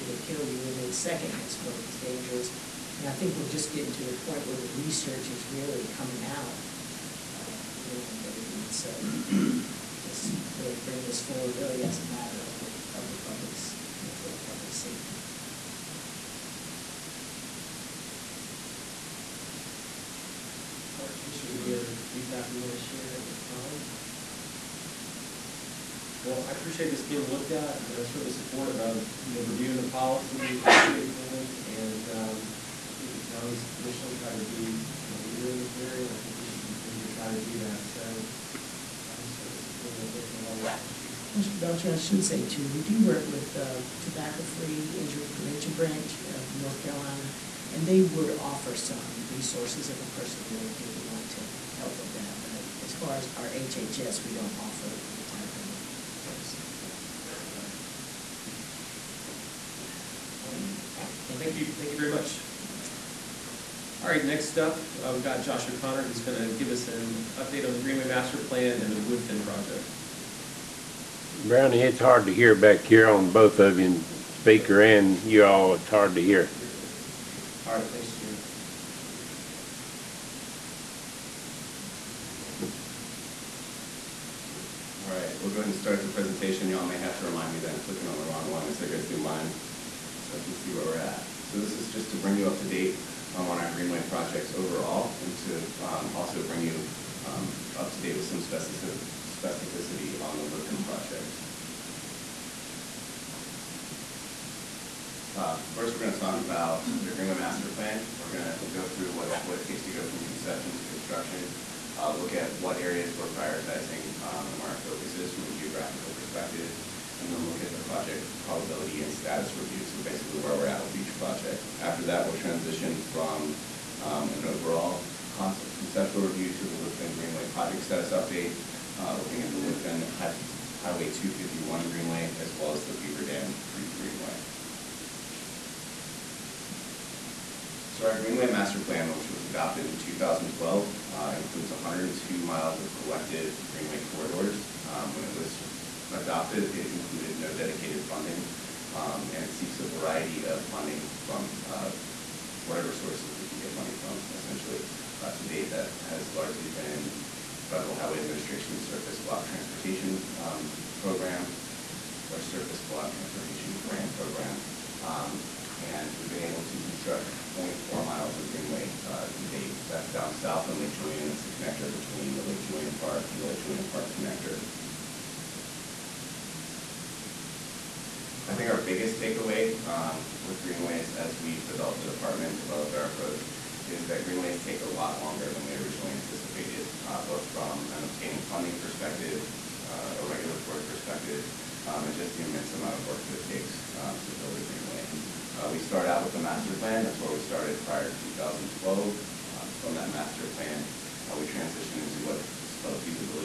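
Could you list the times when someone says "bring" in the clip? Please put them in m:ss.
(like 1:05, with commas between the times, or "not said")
0:10, 1:32, 1:36.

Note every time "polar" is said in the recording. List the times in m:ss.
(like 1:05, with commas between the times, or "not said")
not said.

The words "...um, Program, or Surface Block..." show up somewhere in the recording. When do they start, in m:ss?
2:40.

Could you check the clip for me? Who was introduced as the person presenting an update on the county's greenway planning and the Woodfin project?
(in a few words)
Josh O'Connor.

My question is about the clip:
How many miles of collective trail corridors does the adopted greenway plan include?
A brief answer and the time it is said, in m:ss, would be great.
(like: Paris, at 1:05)
102, at 2:21.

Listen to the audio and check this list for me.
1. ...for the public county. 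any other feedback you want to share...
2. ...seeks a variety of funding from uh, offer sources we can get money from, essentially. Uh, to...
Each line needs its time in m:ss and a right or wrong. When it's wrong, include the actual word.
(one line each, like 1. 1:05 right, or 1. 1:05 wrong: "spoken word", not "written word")
1. 0:14 wrong: "safety", not "county"
2. 2:29 wrong: "whatever", not "offer".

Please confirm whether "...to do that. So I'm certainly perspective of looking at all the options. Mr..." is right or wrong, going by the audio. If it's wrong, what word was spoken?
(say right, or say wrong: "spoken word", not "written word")
wrong: "supportive", not "perspective".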